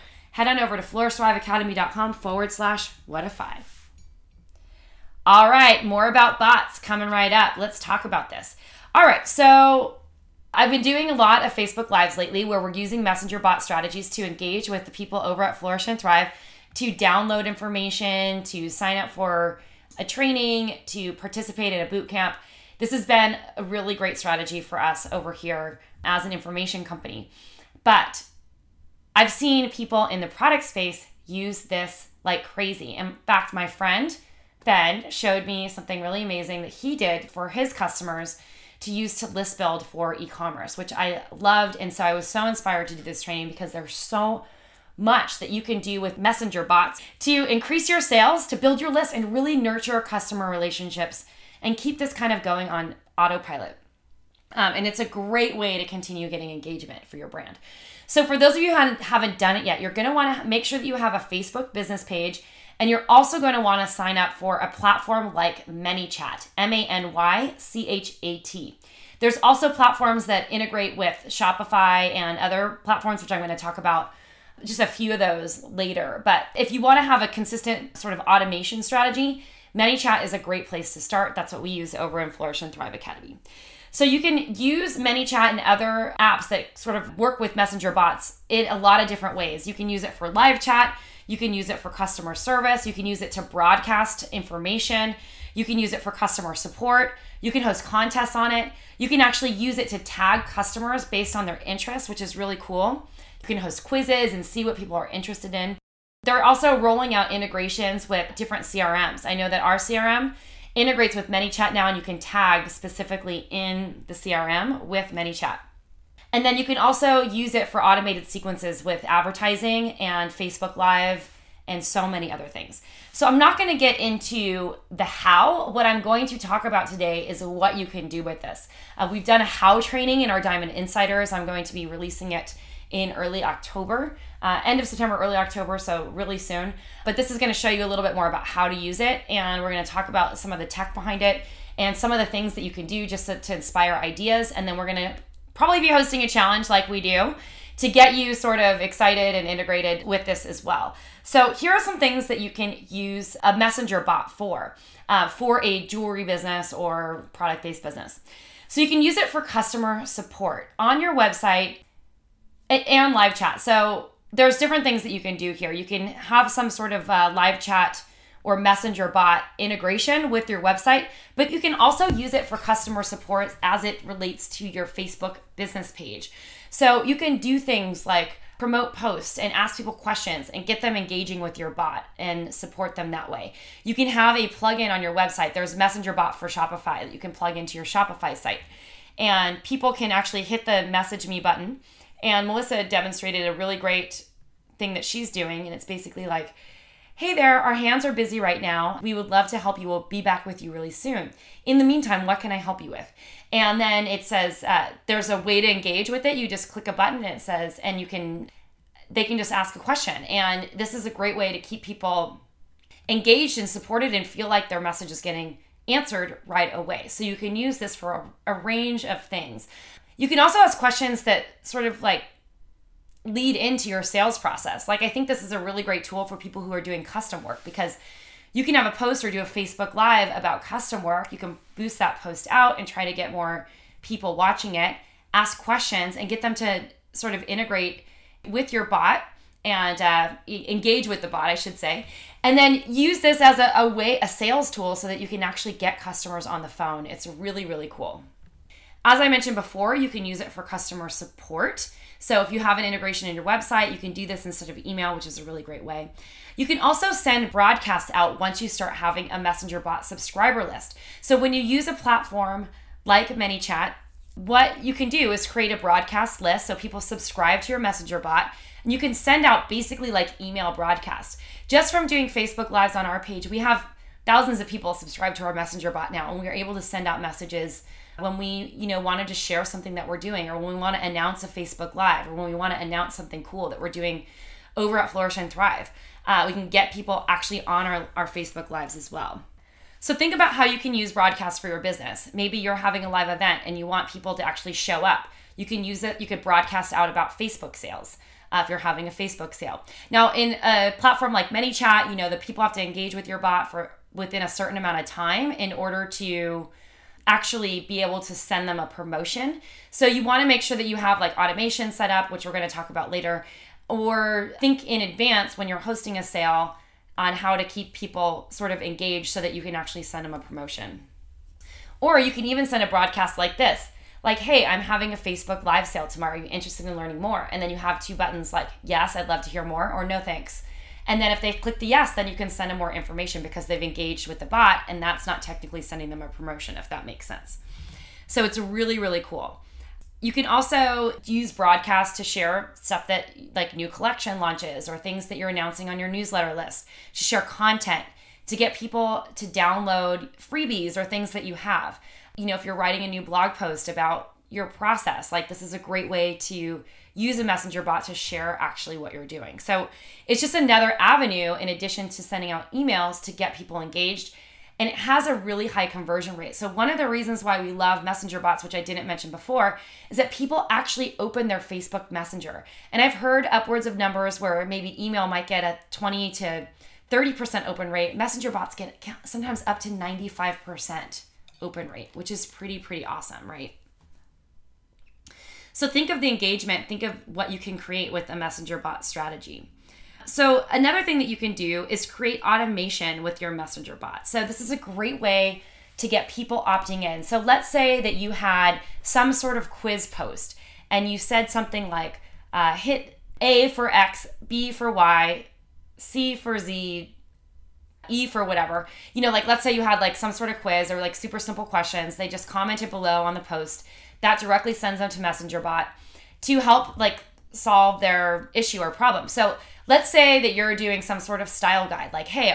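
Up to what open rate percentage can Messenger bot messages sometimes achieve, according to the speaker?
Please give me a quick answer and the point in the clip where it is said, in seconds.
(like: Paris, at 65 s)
95%, at 379 s.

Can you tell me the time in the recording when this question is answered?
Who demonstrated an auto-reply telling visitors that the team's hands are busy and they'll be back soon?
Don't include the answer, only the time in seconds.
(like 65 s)
192 s.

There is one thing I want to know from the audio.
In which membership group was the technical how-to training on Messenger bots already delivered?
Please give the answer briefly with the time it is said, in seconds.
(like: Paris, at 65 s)
Diamond Insiders, at 130 s.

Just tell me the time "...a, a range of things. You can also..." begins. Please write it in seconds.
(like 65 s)
218 s.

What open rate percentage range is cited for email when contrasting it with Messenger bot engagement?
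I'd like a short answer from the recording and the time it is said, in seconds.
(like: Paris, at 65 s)
20 to 30%, at 375 s.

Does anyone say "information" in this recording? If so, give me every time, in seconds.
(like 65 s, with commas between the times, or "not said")
17 s, 26 s, 94 s, 332 s.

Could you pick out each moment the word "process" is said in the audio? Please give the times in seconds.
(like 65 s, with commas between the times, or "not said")
224 s, 354 s.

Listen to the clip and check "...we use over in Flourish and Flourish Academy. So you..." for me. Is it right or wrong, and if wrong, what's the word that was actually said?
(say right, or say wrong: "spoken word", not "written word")
wrong: "Thrive", not "Flourish".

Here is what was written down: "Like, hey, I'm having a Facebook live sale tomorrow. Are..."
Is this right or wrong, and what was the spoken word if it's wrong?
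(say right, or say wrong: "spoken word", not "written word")
right.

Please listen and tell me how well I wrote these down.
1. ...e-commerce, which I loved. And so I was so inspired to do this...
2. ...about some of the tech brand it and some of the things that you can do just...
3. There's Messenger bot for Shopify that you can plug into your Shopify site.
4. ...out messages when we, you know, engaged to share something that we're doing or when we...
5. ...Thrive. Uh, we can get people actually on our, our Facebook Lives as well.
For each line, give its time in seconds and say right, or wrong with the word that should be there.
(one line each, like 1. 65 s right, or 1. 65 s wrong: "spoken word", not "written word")
1. 40 s right
2. 140 s wrong: "behind", not "brand"
3. 185 s right
4. 277 s wrong: "wanted", not "engaged"
5. 285 s right.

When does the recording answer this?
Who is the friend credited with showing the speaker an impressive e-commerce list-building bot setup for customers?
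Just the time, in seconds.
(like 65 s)
33 s.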